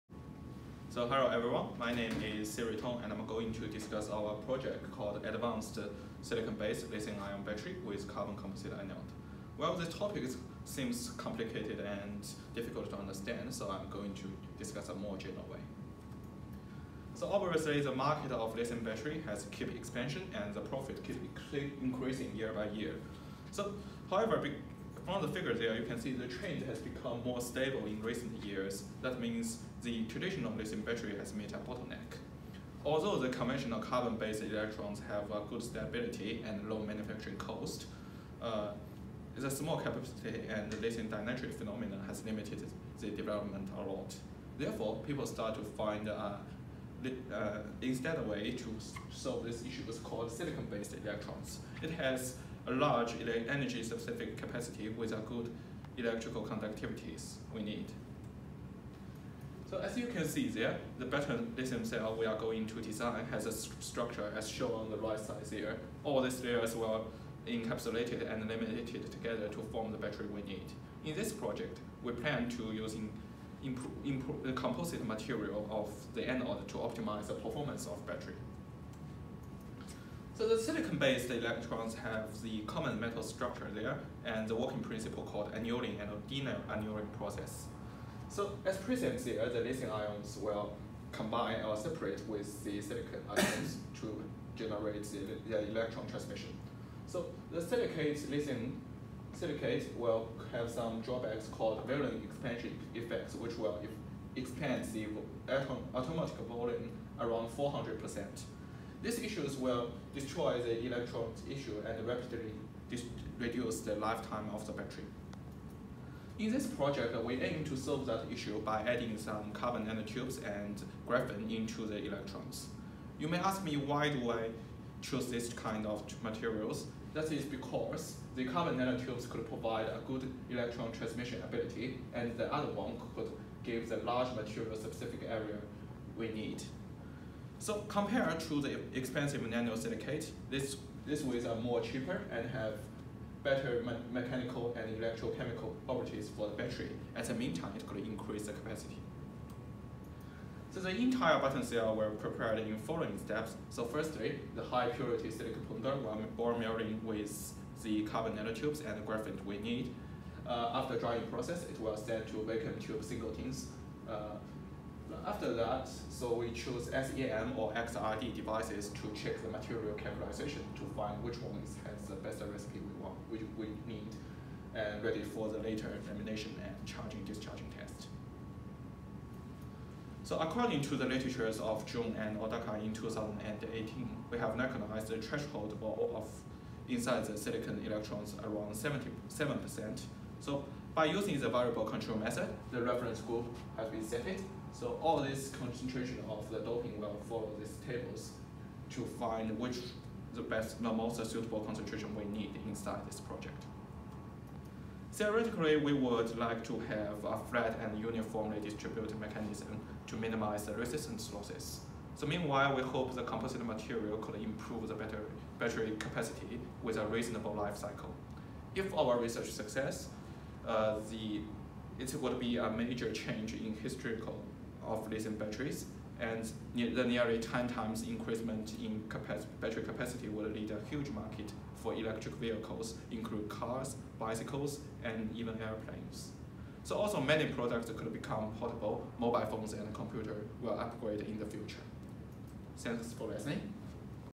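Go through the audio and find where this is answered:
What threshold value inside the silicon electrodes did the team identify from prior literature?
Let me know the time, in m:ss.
3:08.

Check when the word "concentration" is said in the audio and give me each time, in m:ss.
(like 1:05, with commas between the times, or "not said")
3:15, 3:21.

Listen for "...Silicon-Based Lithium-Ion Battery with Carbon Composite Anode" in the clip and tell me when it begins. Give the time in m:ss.
0:06.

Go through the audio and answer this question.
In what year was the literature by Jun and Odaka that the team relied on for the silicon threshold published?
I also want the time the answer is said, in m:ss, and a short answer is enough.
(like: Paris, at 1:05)
2018, at 3:02.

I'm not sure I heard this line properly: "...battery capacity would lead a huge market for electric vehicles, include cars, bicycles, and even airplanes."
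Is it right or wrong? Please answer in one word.
right.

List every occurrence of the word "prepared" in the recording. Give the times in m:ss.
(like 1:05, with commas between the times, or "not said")
2:32.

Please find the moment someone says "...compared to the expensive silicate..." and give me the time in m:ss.
2:17.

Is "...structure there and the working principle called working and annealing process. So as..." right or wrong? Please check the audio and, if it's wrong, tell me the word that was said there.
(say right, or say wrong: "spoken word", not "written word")
wrong: "annealing", not "working".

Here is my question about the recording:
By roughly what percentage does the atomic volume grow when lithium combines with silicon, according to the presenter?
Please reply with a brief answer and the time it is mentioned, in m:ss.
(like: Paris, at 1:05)
400%, at 1:47.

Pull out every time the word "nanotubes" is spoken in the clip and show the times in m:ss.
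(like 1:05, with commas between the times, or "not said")
1:59, 2:08, 2:38.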